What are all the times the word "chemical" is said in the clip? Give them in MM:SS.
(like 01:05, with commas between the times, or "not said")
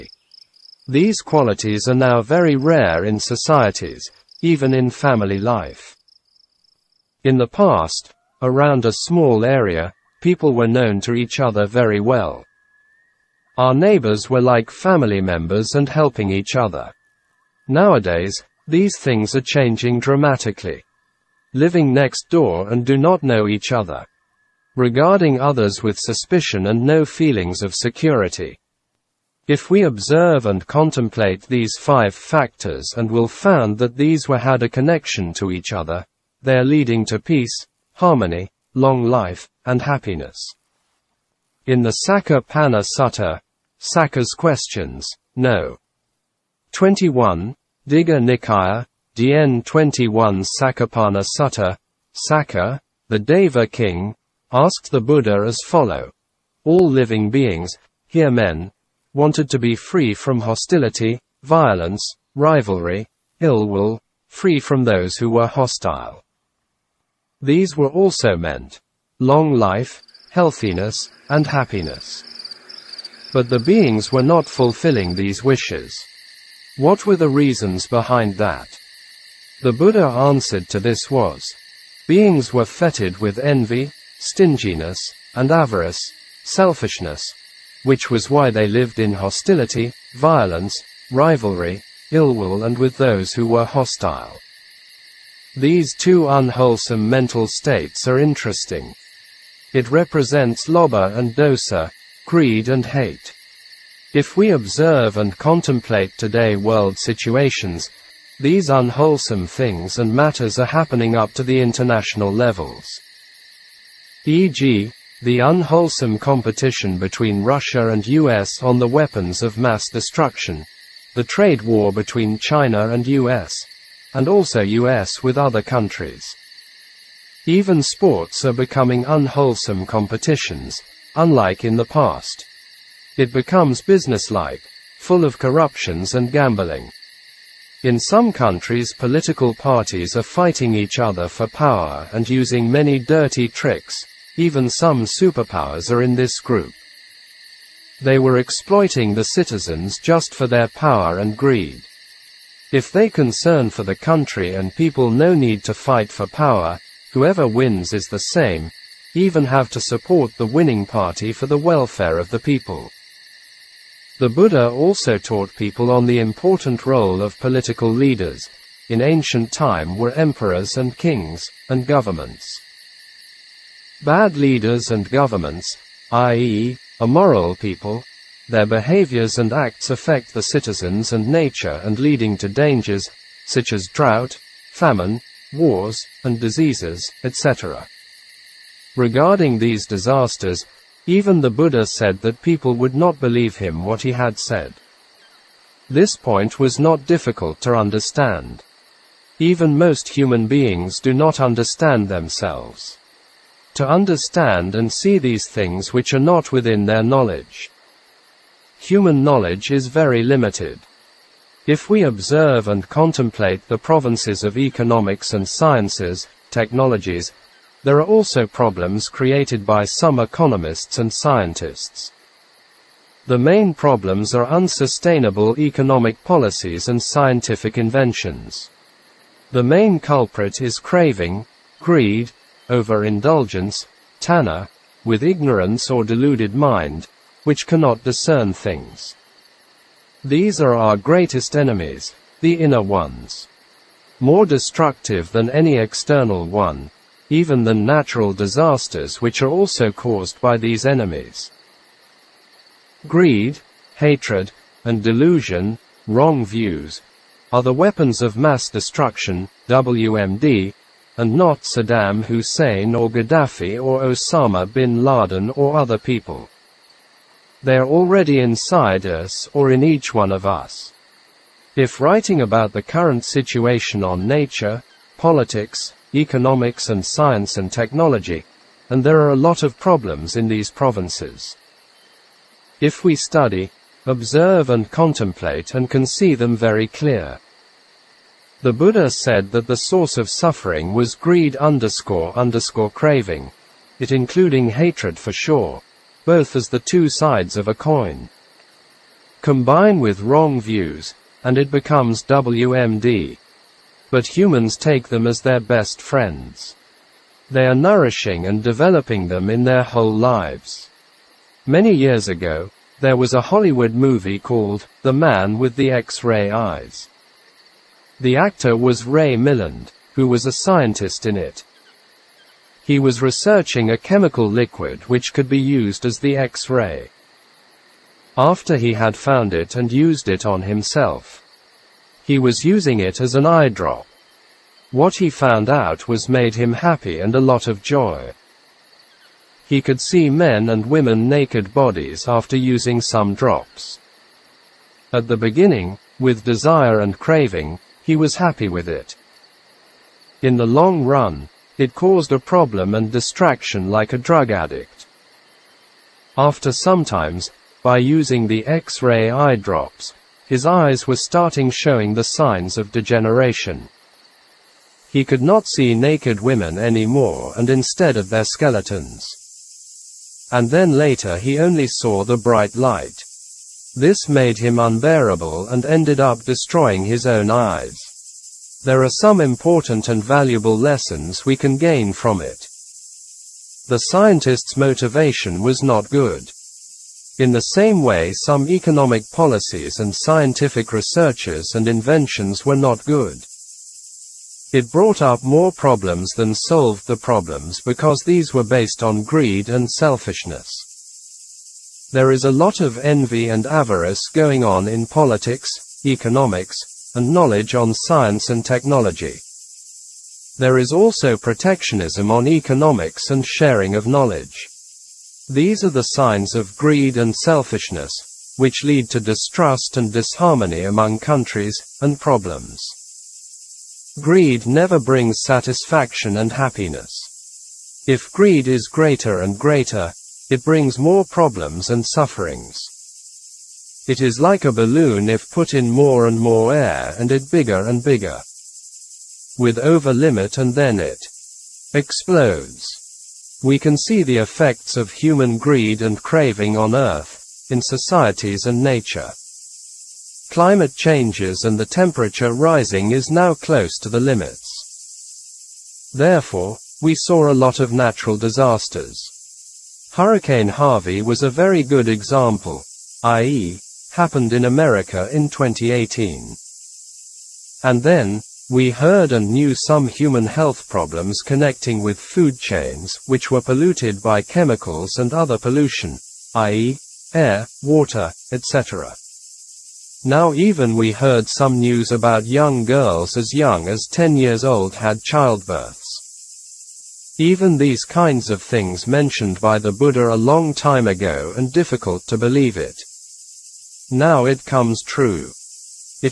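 05:23, 07:54.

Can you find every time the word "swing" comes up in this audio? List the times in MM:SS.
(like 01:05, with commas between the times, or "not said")
not said.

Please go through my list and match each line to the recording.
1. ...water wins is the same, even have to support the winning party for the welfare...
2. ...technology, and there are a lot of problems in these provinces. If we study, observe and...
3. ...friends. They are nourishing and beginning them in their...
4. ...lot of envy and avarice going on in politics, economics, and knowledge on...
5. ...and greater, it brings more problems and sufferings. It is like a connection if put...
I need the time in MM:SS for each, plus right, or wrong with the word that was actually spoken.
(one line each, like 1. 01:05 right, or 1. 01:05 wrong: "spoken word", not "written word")
1. 02:37 wrong: "whoever", not "water"
2. 04:37 right
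3. 05:05 wrong: "developing", not "beginning"
4. 06:42 right
5. 07:09 wrong: "balloon", not "connection".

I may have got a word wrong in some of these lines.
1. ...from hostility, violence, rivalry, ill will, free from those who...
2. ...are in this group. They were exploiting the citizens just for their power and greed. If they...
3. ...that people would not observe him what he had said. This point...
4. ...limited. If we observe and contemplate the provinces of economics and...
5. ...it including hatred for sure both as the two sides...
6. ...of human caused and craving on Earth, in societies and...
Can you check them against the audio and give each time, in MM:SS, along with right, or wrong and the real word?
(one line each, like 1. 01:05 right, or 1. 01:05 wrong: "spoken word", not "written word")
1. 01:00 right
2. 02:25 right
3. 03:12 wrong: "believe", not "observe"
4. 03:30 right
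5. 04:53 right
6. 07:24 wrong: "greed", not "caused".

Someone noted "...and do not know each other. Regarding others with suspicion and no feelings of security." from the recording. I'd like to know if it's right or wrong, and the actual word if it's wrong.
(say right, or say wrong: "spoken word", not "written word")
right.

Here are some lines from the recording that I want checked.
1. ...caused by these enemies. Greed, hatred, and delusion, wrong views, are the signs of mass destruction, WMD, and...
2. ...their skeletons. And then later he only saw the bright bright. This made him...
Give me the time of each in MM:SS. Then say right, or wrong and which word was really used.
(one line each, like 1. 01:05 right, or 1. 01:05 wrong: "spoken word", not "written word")
1. 04:09 wrong: "weapons", not "signs"
2. 06:08 wrong: "light", not "bright".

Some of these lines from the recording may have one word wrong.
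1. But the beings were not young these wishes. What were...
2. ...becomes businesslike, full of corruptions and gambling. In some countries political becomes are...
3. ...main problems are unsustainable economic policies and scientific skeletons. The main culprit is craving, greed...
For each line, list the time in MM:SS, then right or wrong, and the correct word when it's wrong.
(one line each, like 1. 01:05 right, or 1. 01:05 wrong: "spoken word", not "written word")
1. 01:13 wrong: "fulfilling", not "young"
2. 02:13 wrong: "parties", not "becomes"
3. 03:43 wrong: "inventions", not "skeletons".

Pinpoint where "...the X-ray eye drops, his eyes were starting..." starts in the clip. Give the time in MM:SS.
05:58.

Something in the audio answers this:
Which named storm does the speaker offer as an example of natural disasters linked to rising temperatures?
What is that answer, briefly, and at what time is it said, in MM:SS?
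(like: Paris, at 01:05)
Hurricane Harvey, at 07:40.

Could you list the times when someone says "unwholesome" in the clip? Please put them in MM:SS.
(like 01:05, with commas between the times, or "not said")
01:36, 01:48, 01:55, 02:09.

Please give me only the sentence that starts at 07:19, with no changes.
With over limit and then it explodes.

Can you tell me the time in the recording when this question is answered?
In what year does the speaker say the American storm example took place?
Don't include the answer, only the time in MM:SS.
07:45.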